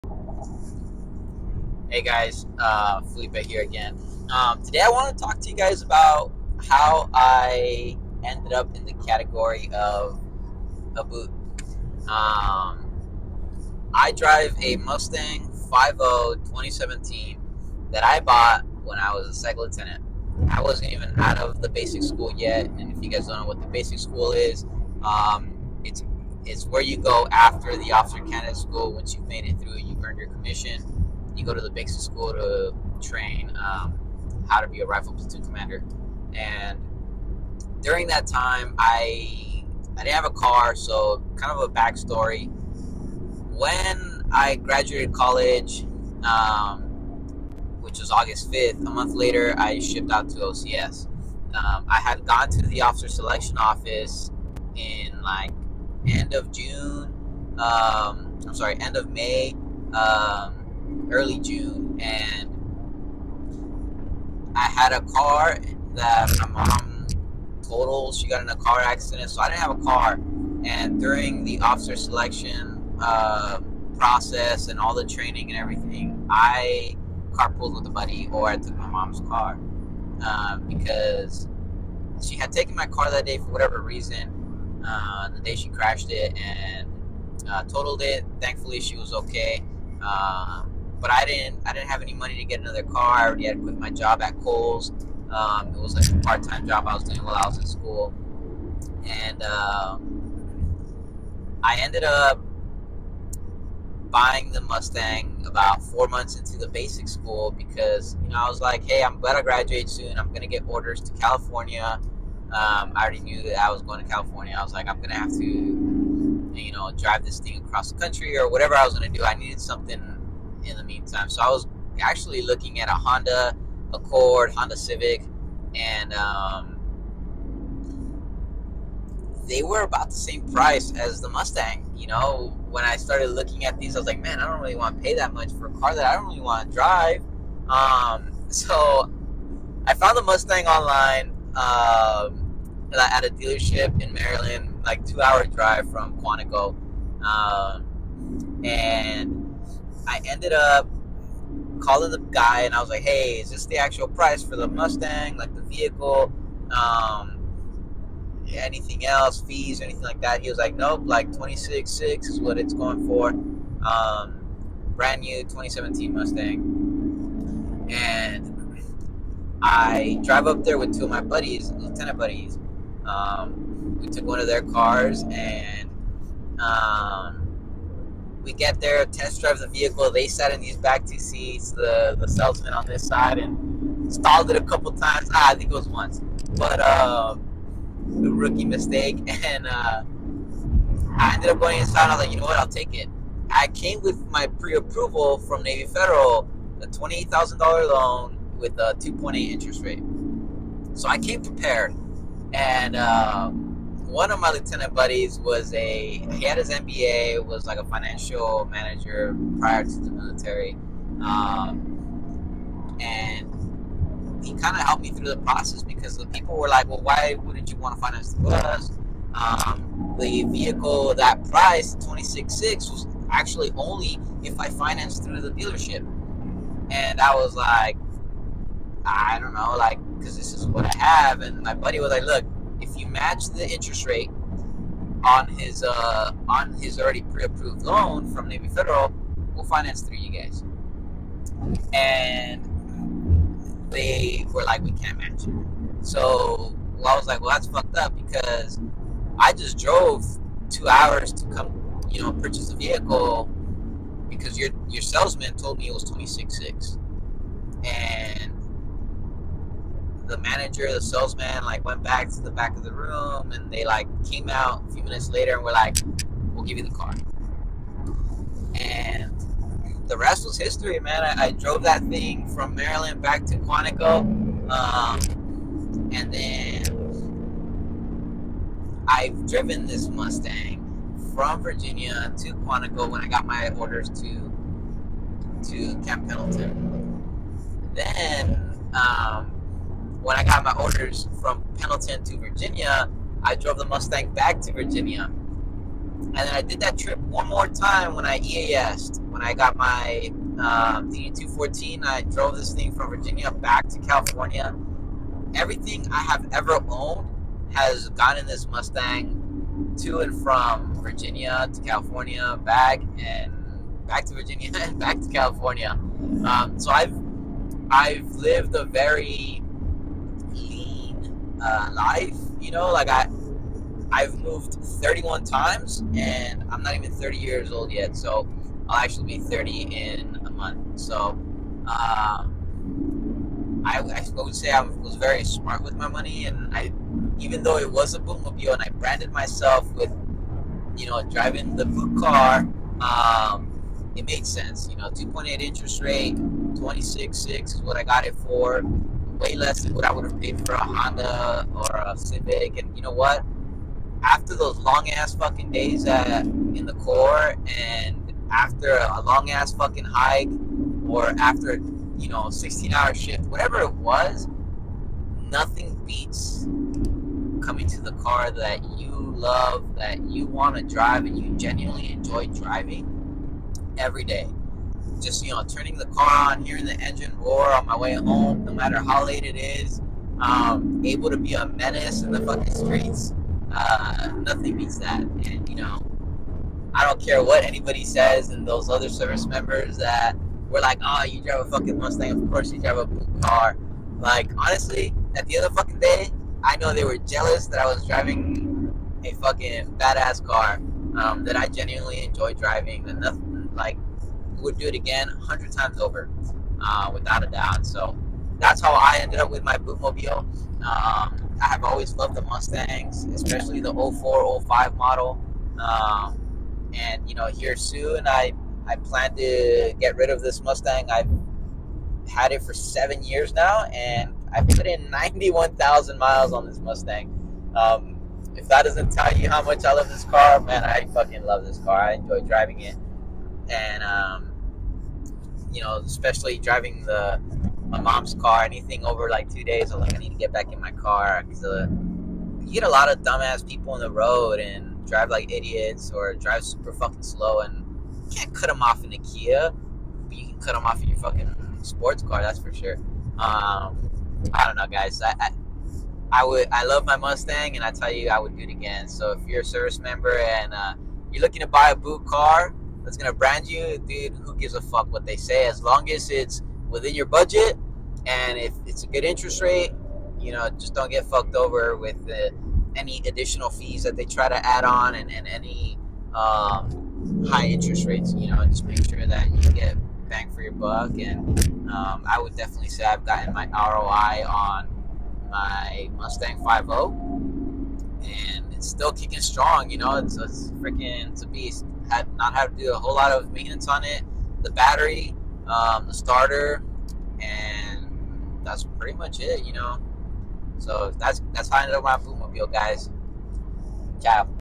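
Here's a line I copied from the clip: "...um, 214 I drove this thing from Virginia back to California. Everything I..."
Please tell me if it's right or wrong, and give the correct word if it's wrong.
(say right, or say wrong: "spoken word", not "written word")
right.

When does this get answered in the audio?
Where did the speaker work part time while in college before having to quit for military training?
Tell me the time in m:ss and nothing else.
1:34.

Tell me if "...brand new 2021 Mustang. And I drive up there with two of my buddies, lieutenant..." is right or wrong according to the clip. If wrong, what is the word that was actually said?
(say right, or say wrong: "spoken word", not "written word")
wrong: "2017", not "2021".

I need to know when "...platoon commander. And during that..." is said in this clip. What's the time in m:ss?
0:35.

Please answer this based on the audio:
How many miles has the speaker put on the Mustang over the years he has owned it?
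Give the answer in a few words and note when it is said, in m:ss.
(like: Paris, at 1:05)
91,000, at 7:05.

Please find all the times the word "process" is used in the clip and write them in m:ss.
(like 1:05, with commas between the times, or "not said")
1:13, 3:35.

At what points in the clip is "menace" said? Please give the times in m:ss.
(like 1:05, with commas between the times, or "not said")
6:21.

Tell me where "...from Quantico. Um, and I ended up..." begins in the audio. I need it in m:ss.
2:25.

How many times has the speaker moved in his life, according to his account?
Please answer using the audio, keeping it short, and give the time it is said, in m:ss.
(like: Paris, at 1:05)
31, at 5:24.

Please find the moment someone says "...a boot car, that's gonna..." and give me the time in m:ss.
7:41.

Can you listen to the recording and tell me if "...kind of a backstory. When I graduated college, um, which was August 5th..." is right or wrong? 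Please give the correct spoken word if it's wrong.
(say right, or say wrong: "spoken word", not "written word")
right.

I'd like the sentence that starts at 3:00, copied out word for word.
They sat in these back two seats, the, the salesman on this side, and stalled it a couple times.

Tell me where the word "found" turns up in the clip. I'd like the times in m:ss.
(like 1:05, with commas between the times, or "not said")
2:19.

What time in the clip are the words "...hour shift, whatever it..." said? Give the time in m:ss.
6:02.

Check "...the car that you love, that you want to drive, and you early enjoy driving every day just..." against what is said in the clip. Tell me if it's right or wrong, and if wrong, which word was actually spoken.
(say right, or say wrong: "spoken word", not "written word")
wrong: "genuinely", not "early".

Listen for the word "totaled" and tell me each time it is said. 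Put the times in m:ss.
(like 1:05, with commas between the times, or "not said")
1:07, 1:27.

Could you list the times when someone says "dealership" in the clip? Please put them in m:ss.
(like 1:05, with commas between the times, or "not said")
2:23, 3:45.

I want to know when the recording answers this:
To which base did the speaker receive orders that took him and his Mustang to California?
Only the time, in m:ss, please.
4:46.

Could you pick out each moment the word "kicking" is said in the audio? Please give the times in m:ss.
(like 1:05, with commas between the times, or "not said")
8:09.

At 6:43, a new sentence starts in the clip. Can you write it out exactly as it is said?
And nothing like would do it again a hundred times over, uh, without a doubt.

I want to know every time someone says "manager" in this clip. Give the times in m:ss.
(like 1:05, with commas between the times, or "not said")
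3:28, 4:20.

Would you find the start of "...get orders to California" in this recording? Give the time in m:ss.
1:50.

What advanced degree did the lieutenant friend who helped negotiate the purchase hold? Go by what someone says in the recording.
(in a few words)
MBA.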